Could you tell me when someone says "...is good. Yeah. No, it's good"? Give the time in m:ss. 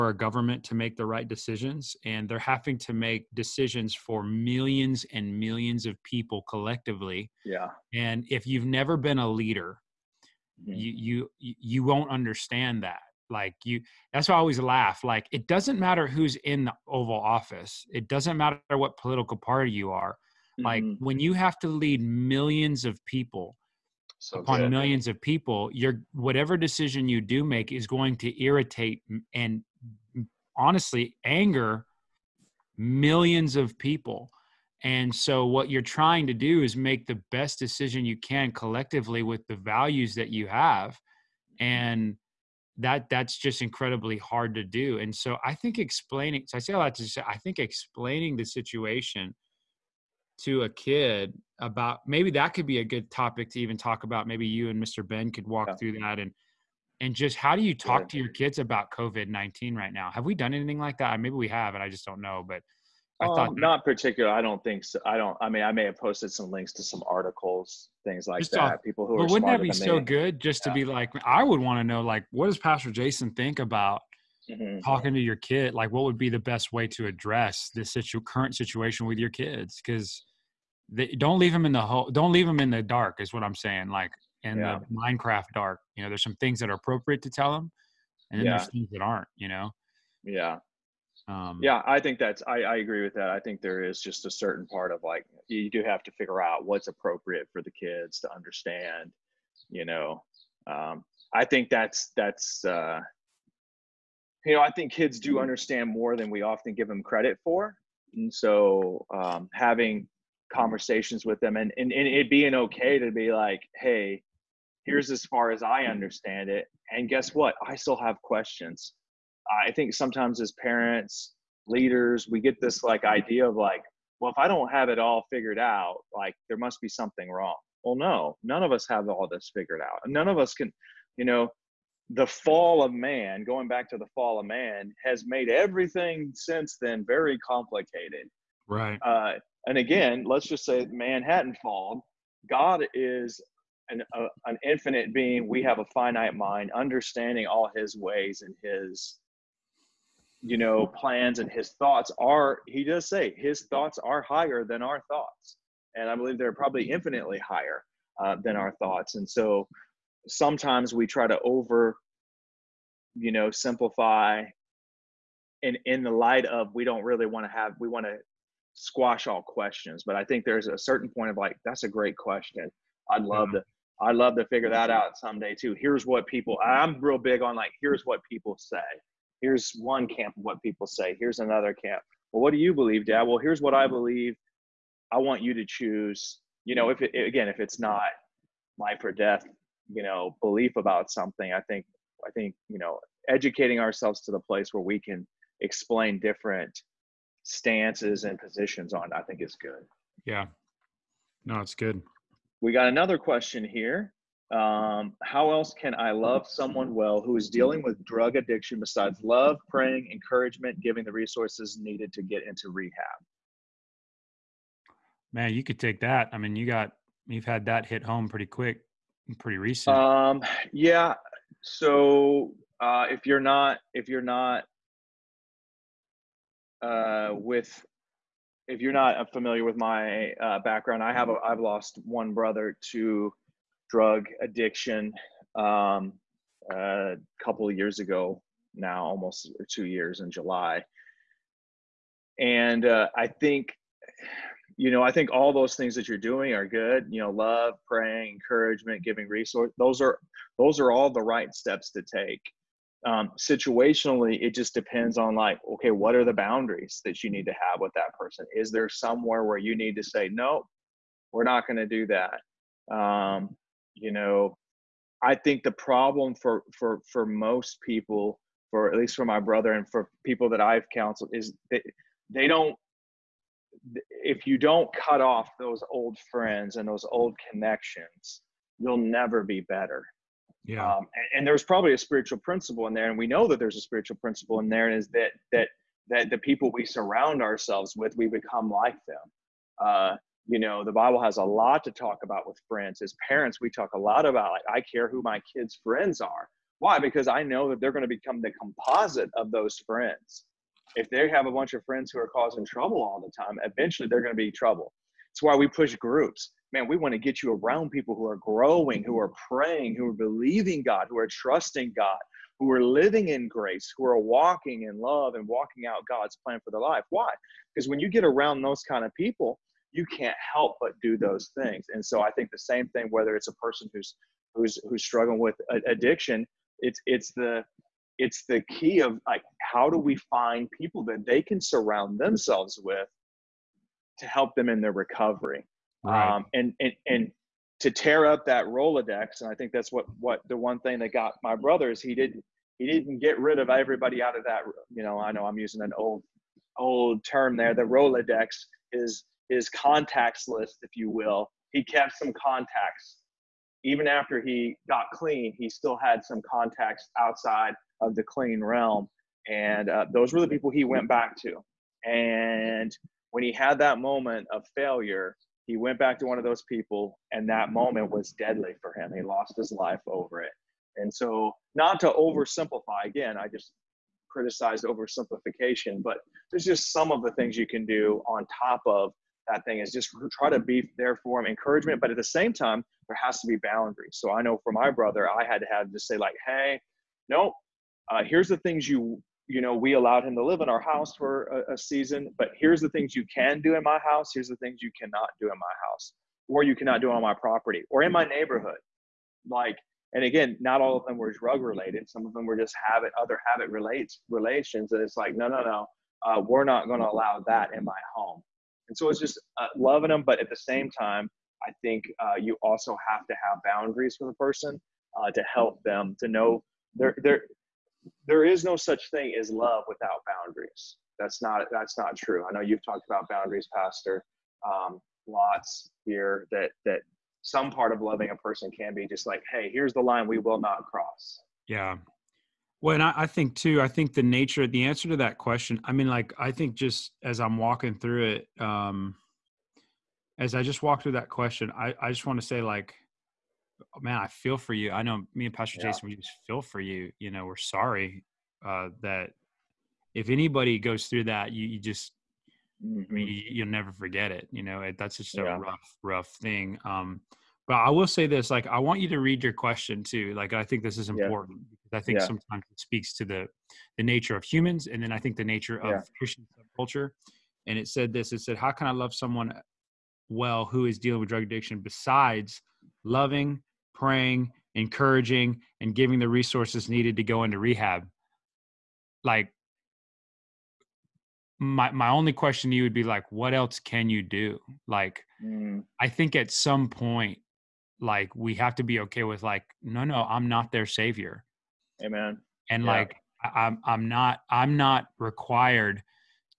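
3:19.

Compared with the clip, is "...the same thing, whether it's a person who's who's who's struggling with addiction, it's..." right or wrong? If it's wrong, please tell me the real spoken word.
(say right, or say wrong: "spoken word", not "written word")
right.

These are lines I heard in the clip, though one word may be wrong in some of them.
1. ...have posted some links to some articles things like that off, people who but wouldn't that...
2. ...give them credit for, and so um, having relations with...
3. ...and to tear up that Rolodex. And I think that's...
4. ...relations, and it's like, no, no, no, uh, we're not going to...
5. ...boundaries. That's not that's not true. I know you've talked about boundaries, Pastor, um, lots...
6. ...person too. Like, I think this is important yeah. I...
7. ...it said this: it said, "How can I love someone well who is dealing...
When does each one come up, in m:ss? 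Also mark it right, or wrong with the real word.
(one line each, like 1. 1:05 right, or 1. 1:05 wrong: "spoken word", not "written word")
1. 1:05 right
2. 1:46 wrong: "conversations", not "relations"
3. 5:37 right
4. 6:44 right
5. 7:00 right
6. 7:39 wrong: "question", not "person"
7. 7:47 right.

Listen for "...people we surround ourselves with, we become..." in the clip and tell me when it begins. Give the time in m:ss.
4:46.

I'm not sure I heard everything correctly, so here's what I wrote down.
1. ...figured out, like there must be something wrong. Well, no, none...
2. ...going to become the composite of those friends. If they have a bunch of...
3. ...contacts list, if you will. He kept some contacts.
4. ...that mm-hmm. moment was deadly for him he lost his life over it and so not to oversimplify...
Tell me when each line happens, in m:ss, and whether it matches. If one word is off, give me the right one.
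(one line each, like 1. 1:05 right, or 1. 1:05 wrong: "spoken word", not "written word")
1. 2:05 right
2. 4:57 right
3. 5:49 right
4. 6:07 right.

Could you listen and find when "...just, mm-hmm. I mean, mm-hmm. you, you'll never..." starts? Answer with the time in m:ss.
7:31.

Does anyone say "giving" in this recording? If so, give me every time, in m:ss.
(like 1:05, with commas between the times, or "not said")
3:30, 4:09, 7:55.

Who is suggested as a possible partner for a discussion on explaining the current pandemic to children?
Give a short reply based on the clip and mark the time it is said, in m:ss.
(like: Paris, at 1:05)
Mr. Ben, at 0:54.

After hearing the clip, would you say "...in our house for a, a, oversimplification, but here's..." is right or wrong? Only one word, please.
wrong.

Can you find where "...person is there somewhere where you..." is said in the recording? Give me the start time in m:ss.
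4:18.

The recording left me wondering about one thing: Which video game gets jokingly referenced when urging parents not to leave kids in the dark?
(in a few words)
Minecraft.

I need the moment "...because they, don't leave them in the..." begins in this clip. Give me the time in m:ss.
1:19.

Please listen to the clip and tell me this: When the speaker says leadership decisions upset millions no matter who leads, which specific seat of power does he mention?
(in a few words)
Oval Office.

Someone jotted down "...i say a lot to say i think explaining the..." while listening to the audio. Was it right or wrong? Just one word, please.
right.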